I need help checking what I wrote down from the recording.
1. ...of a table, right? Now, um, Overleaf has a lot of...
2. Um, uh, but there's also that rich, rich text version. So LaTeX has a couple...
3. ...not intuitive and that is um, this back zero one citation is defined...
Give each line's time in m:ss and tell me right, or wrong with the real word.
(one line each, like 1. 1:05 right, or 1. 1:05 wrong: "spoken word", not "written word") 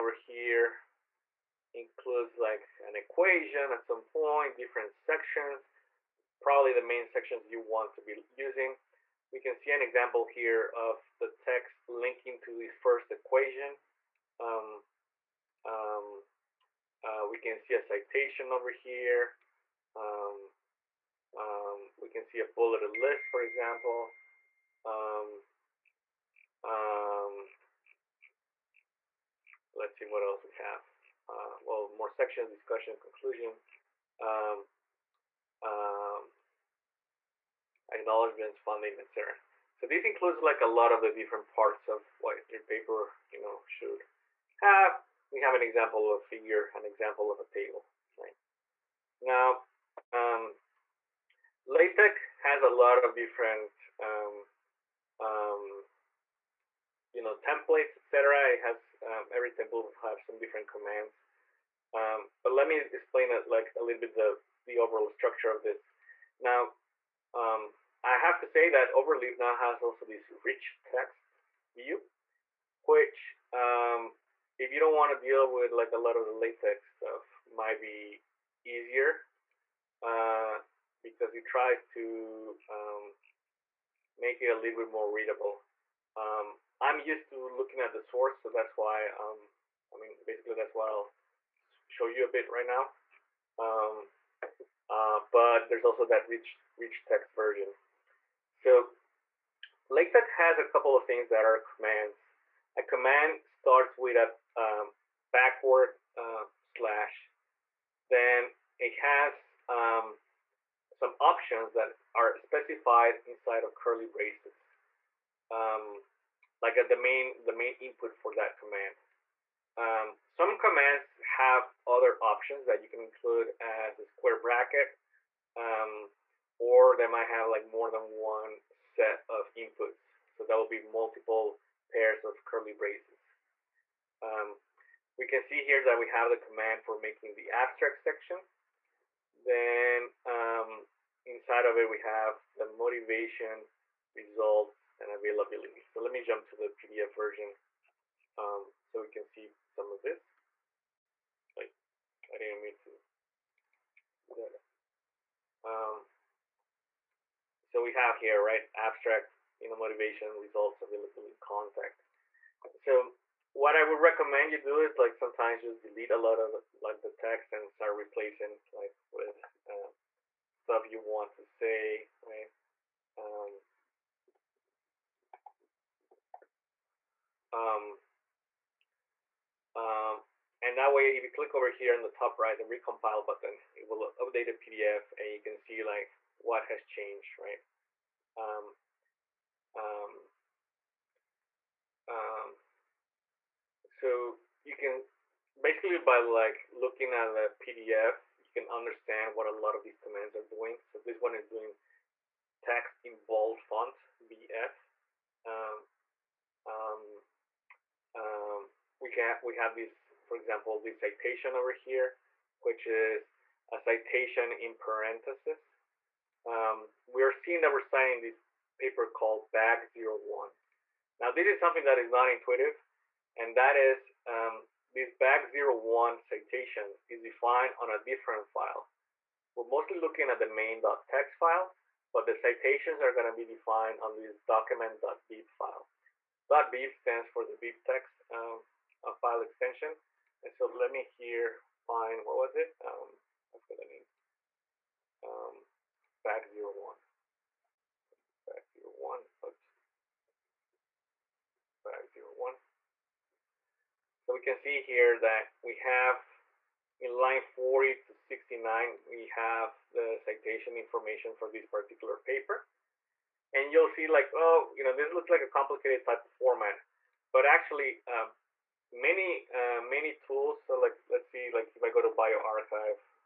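1. 0:47 wrong: "LaTeX", not "Overleaf"
2. 1:33 right
3. 3:42 right.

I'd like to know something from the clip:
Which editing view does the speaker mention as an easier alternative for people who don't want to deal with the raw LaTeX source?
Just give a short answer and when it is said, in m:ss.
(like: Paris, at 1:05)
rich text view, at 1:10.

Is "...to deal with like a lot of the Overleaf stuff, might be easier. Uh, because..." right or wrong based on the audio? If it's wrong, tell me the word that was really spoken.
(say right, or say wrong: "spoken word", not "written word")
wrong: "LaTeX", not "Overleaf".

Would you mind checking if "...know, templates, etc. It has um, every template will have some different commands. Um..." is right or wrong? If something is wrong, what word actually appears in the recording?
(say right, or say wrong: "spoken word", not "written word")
right.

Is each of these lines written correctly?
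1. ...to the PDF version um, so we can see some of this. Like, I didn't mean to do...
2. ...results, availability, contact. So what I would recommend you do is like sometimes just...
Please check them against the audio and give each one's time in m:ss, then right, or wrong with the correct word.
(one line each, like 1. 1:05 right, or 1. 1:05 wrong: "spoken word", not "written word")
1. 2:26 right
2. 2:40 right.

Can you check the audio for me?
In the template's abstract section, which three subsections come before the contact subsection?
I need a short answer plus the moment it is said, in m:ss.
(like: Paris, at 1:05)
motivation, results, and availability, at 2:22.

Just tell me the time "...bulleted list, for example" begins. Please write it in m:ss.
0:22.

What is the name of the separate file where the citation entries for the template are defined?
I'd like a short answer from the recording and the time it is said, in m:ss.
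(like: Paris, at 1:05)
document.bib, at 3:54.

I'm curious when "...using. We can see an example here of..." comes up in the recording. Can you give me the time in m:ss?
0:08.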